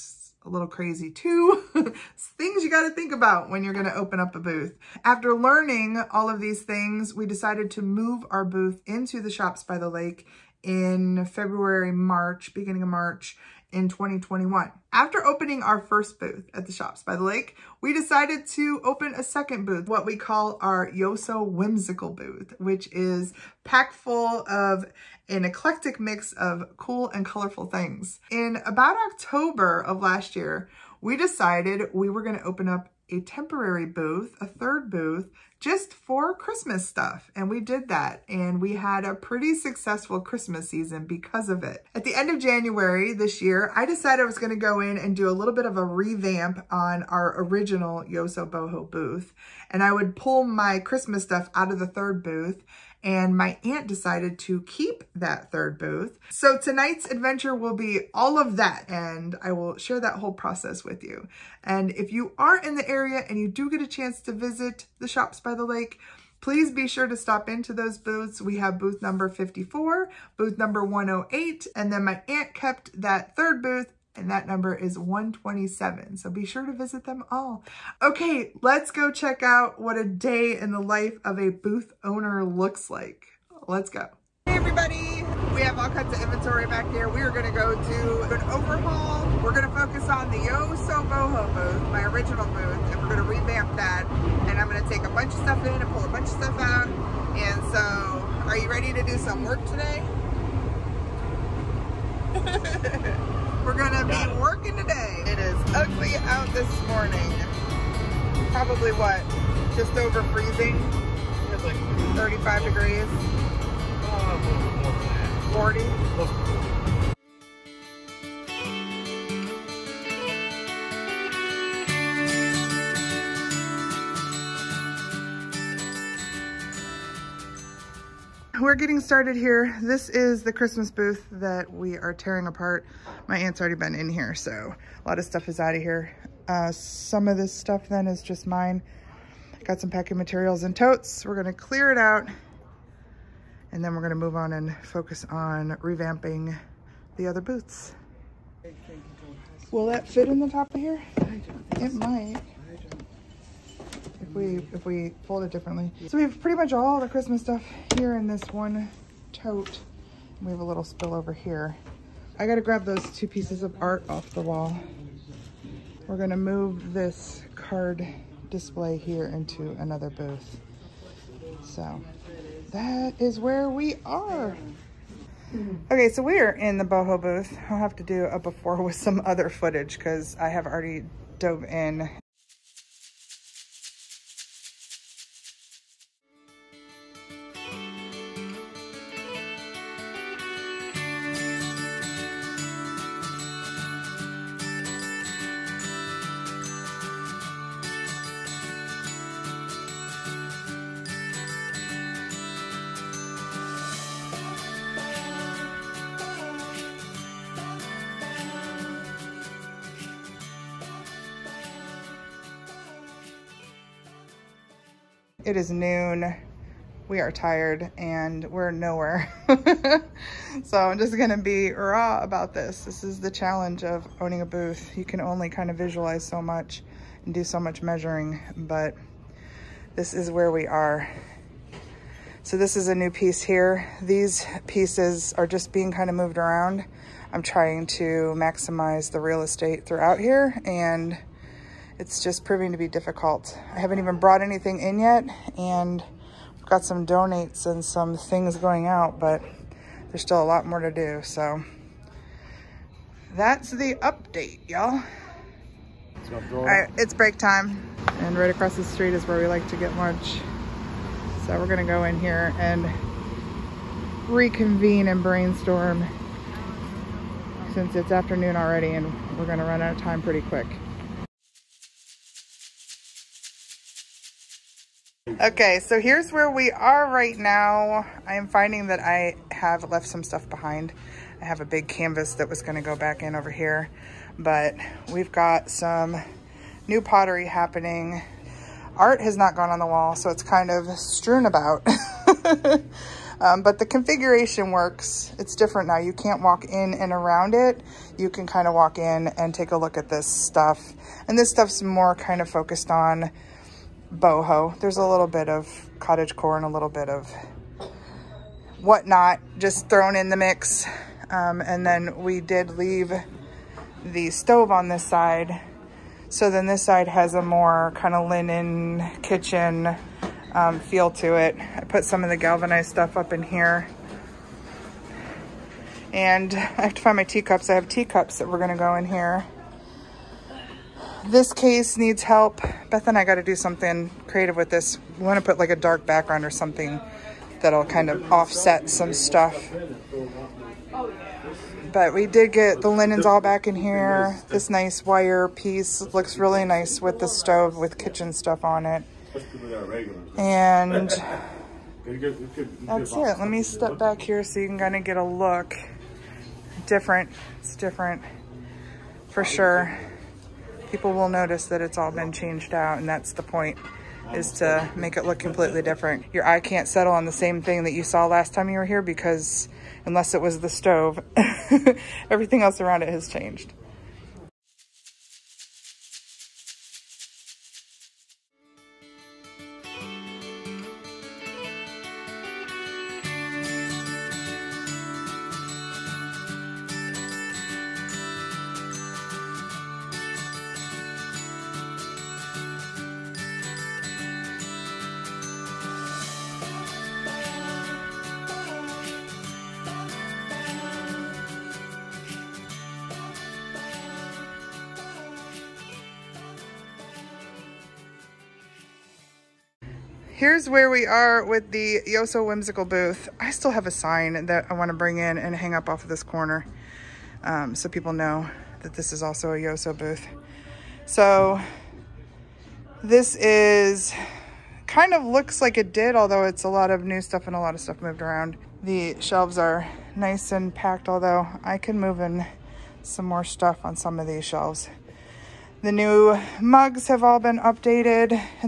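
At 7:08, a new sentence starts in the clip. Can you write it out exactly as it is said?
The shelves are nice and packed, although I can move in some more stuff on some of these shelves.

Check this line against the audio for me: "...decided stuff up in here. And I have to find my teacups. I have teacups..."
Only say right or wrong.
wrong.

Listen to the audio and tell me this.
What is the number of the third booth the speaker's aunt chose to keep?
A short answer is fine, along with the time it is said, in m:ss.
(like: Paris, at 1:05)
127, at 1:14.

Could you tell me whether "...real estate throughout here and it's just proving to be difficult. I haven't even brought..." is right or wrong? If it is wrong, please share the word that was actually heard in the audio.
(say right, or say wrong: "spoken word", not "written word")
right.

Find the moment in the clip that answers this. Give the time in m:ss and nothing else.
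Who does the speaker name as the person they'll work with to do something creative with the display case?
5:32.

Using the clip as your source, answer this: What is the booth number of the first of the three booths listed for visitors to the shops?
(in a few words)
54.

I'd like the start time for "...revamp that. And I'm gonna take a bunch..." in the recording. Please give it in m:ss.
1:33.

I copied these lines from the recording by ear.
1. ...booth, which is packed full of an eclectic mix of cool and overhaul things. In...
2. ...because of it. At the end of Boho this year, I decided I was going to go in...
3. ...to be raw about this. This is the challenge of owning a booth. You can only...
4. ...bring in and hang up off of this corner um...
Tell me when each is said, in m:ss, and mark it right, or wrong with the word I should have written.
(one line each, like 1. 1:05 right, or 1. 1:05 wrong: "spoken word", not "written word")
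1. 0:22 wrong: "colorful", not "overhaul"
2. 0:41 wrong: "January", not "Boho"
3. 3:41 right
4. 6:54 right.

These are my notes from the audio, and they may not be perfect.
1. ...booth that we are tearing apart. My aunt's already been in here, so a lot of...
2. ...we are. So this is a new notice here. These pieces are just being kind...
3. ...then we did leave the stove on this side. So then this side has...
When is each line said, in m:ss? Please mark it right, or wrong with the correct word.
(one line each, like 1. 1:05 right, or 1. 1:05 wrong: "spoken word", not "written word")
1. 2:10 right
2. 3:50 wrong: "piece", not "notice"
3. 5:11 right.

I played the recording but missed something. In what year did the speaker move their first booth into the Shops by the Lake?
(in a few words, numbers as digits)
2021.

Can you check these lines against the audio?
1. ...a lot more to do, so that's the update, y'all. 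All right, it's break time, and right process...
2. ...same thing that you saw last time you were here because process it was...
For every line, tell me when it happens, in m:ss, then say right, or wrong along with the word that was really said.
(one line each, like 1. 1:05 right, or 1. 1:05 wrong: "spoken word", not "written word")
1. 4:10 wrong: "across", not "process"
2. 6:07 wrong: "unless", not "process".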